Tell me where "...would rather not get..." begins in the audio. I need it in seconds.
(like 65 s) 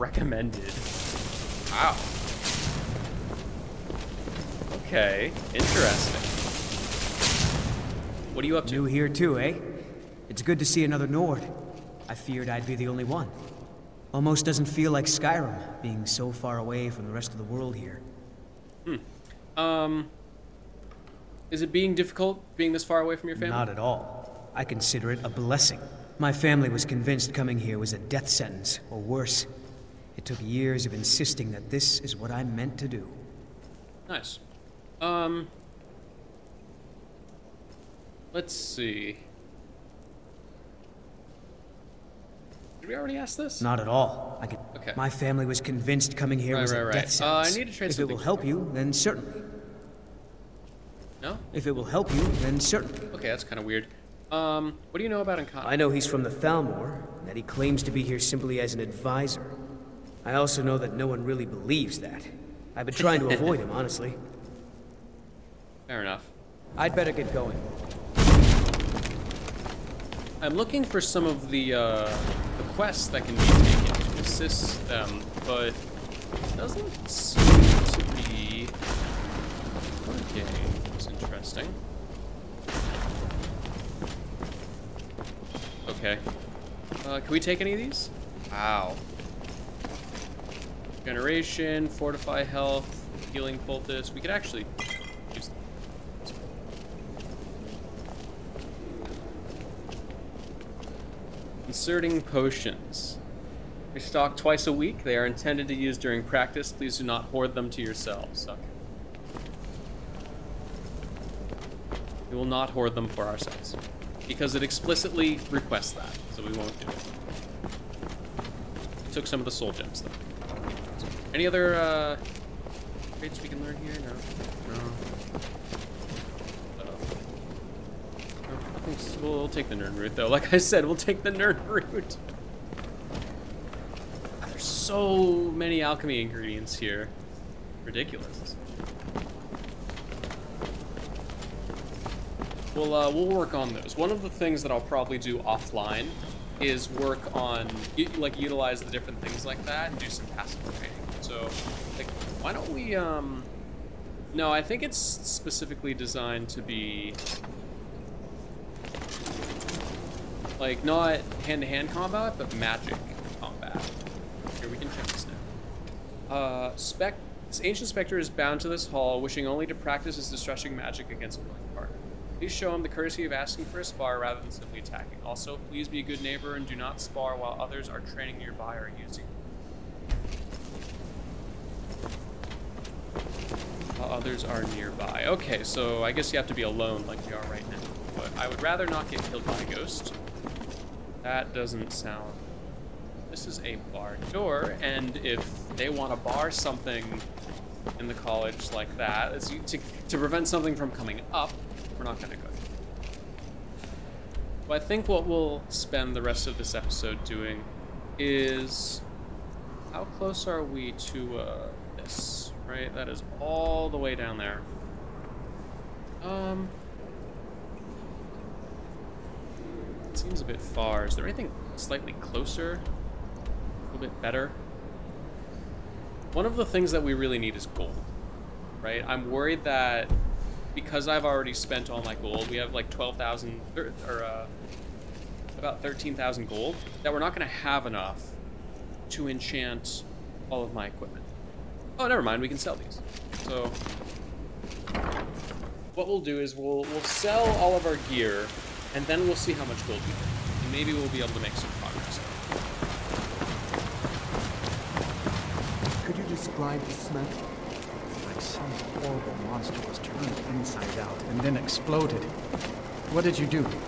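188 s.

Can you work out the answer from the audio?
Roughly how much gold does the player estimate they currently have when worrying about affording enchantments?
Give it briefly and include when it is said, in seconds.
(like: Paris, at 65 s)
13,000 gold, at 235 s.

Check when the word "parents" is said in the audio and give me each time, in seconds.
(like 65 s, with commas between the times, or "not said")
not said.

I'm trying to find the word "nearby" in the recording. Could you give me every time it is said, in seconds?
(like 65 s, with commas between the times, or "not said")
178 s, 184 s.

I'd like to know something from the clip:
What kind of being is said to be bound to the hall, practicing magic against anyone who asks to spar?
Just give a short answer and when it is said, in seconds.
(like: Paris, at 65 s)
Ancient specter, at 167 s.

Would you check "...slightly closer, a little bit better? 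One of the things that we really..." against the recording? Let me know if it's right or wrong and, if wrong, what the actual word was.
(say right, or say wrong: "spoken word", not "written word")
right.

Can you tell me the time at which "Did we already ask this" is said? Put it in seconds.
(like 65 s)
42 s.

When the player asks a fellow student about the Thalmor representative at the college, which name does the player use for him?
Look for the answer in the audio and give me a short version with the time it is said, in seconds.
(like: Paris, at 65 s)
Ankata, at 55 s.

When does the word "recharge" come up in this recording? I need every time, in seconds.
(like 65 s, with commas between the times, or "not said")
not said.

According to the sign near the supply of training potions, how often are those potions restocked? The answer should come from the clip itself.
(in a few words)
Twice a week.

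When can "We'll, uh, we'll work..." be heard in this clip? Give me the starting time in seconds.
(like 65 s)
142 s.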